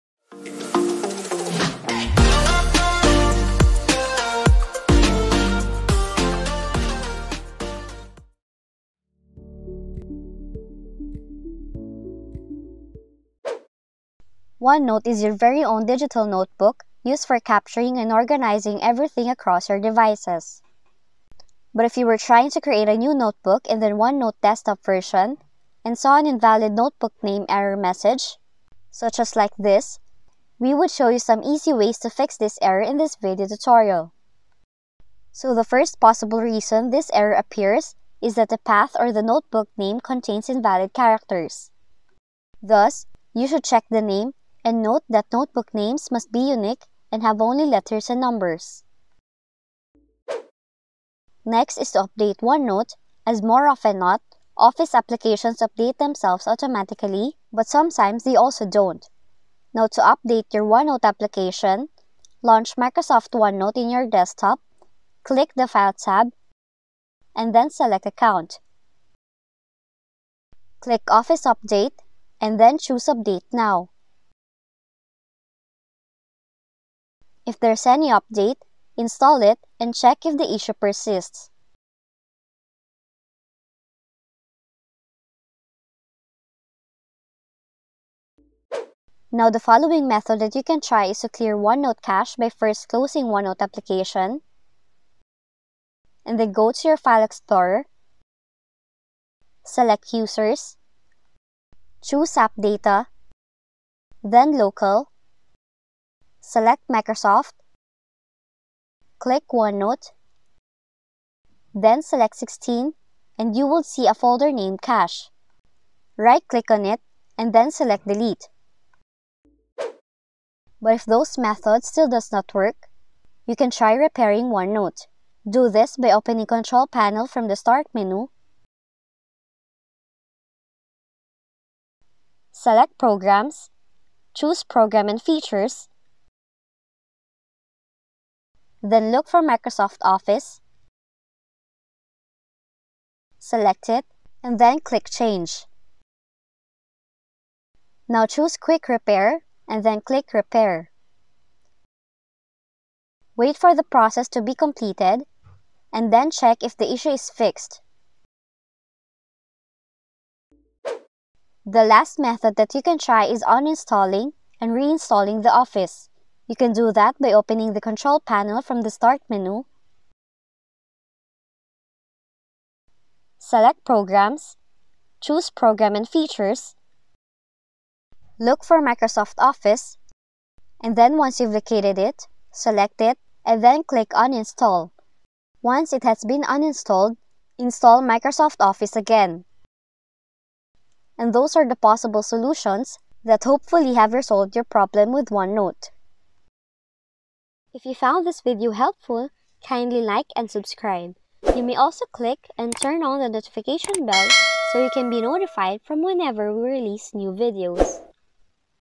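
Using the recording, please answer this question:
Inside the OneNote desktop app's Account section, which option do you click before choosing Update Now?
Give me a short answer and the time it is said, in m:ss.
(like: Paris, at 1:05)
Office Update, at 1:11.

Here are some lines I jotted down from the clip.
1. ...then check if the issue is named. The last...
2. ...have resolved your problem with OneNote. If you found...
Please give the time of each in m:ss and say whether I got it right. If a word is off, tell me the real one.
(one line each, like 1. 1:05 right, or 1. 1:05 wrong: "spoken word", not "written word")
1. 2:36 wrong: "fixed", not "named"
2. 3:13 right.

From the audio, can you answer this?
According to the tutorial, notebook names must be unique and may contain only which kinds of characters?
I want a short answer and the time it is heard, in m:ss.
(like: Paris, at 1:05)
letters and numbers, at 0:47.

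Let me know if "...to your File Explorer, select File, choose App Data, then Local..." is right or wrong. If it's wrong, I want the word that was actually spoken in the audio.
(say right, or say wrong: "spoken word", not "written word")
wrong: "Users", not "File".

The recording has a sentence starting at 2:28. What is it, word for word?
Now choose Quick Repair and then click Repair.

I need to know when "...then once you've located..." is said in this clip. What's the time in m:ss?
3:00.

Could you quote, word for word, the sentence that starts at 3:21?
You may also click and turn on the notification bell so you can be notified from whenever we release new videos.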